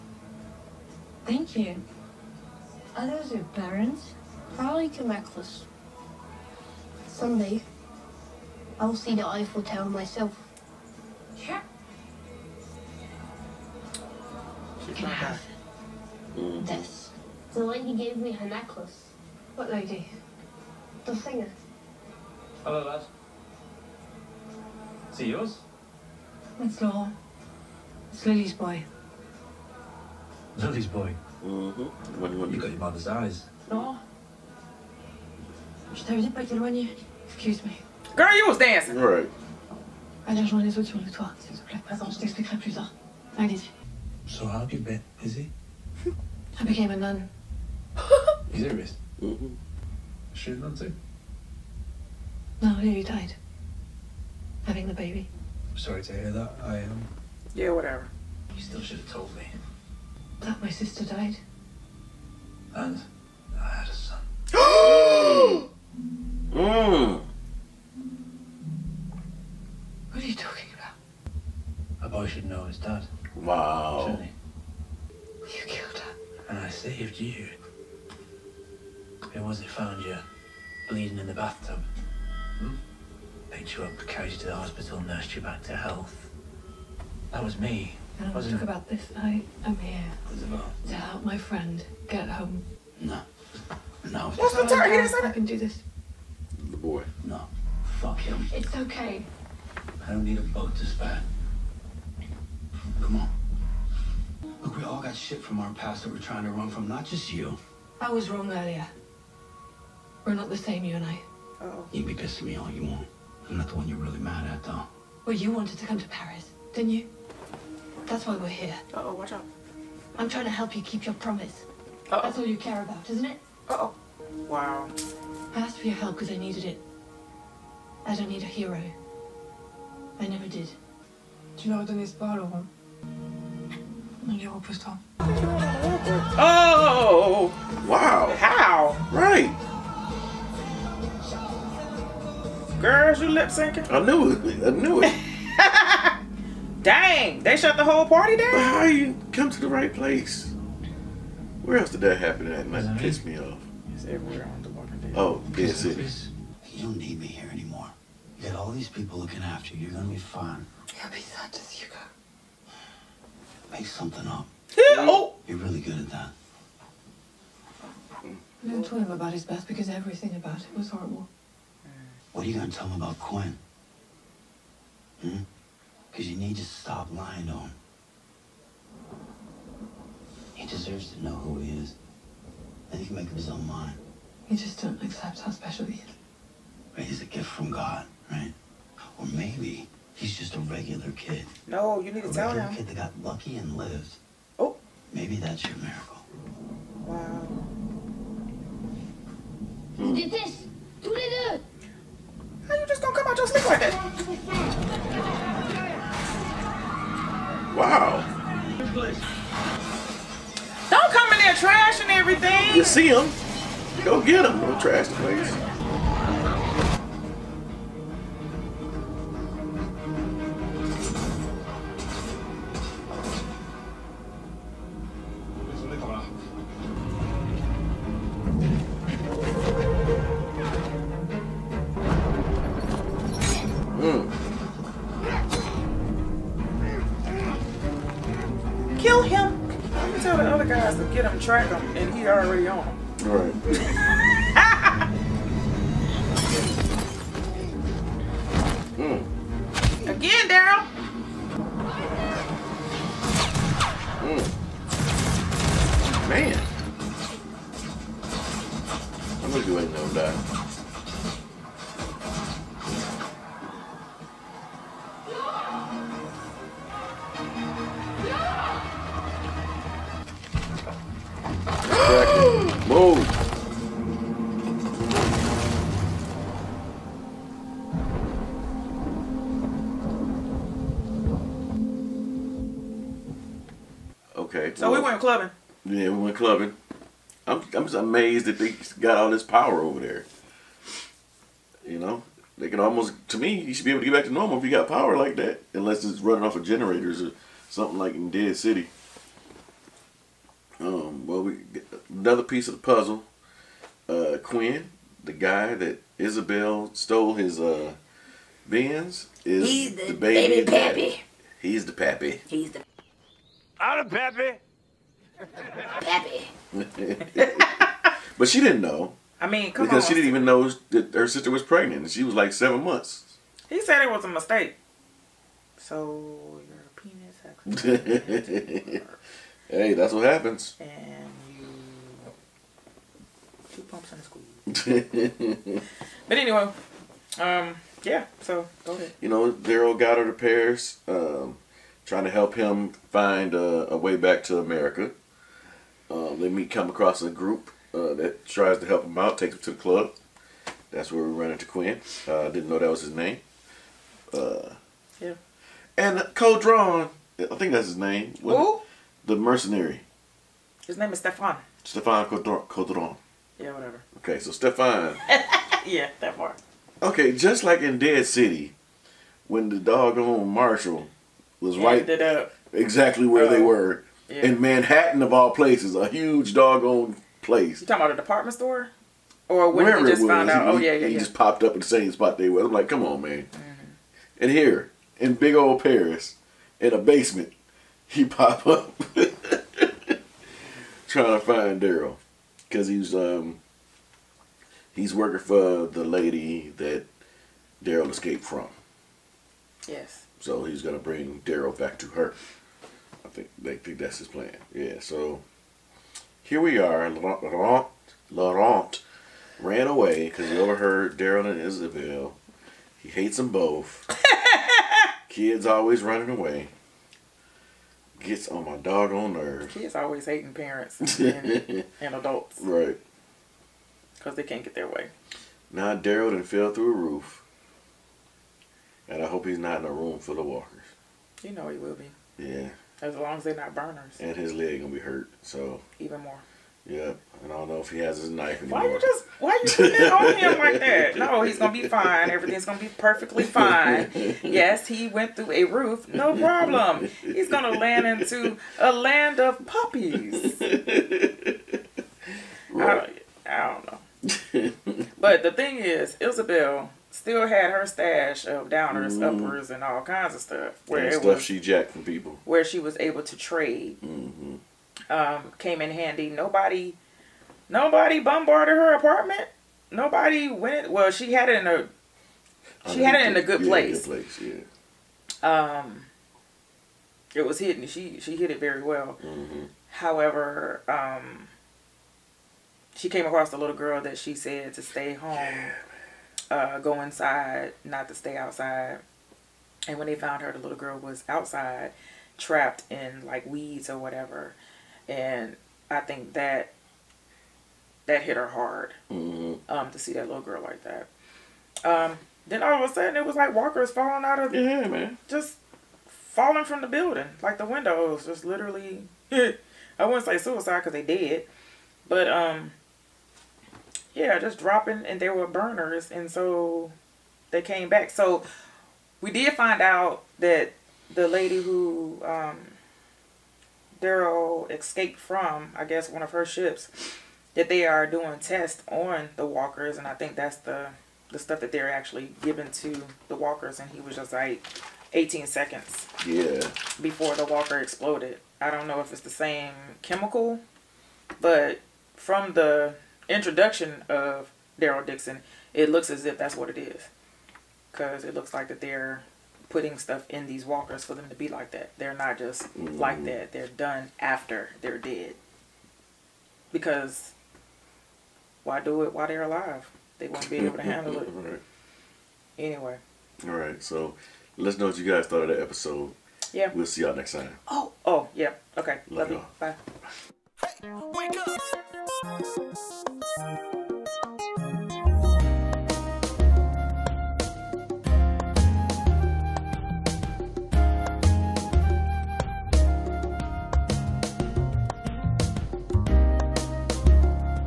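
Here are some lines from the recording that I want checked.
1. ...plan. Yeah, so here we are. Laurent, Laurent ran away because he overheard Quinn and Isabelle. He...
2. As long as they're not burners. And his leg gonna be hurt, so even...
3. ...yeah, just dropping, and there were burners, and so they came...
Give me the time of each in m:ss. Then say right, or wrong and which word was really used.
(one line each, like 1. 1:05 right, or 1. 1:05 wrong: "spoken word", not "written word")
1. 6:44 wrong: "Daryl", not "Quinn"
2. 7:13 right
3. 8:34 right.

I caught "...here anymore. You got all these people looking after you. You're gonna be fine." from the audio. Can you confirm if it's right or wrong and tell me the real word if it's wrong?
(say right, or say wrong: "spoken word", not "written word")
right.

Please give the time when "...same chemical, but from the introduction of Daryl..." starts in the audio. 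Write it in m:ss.
8:59.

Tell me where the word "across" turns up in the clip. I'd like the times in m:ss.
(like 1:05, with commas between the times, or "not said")
5:46, 8:03.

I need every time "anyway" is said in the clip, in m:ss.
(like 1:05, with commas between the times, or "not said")
5:36, 9:22.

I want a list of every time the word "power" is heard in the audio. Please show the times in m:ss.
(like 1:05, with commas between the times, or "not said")
4:49, 4:54.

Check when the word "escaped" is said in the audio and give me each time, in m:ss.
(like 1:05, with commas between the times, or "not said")
6:38, 8:44.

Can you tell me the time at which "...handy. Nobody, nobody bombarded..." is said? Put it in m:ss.
7:45.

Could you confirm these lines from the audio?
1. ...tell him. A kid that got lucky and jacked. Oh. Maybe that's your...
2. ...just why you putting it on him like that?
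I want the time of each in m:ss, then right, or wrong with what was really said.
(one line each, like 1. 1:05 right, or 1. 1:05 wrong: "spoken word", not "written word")
1. 3:12 wrong: "lived", not "jacked"
2. 7:18 right.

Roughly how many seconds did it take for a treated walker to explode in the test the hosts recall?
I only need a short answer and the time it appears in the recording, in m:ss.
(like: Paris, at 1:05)
18, at 8:55.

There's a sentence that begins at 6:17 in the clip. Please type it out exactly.
You talking about a department store?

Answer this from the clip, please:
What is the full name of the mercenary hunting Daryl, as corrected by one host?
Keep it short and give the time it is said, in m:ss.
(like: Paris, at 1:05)
Stefan Codron, at 6:01.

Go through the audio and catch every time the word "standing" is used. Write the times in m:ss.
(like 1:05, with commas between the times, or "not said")
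not said.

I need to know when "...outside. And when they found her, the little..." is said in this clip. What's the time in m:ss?
8:08.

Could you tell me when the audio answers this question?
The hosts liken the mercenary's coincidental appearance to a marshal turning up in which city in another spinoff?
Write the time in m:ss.
6:14.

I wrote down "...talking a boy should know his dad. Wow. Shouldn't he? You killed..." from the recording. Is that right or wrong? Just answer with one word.
right.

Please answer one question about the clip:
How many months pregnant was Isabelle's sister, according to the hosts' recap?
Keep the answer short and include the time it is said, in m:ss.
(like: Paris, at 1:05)
7, at 5:22.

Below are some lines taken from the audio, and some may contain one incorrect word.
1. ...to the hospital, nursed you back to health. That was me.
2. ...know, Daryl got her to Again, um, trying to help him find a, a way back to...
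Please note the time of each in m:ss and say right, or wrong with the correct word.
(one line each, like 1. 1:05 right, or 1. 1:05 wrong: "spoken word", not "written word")
1. 1:24 right
2. 5:39 wrong: "Paris", not "Again".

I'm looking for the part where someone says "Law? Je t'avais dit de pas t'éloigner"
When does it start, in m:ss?
0:33.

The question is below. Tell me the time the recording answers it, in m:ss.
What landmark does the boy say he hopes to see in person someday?
0:09.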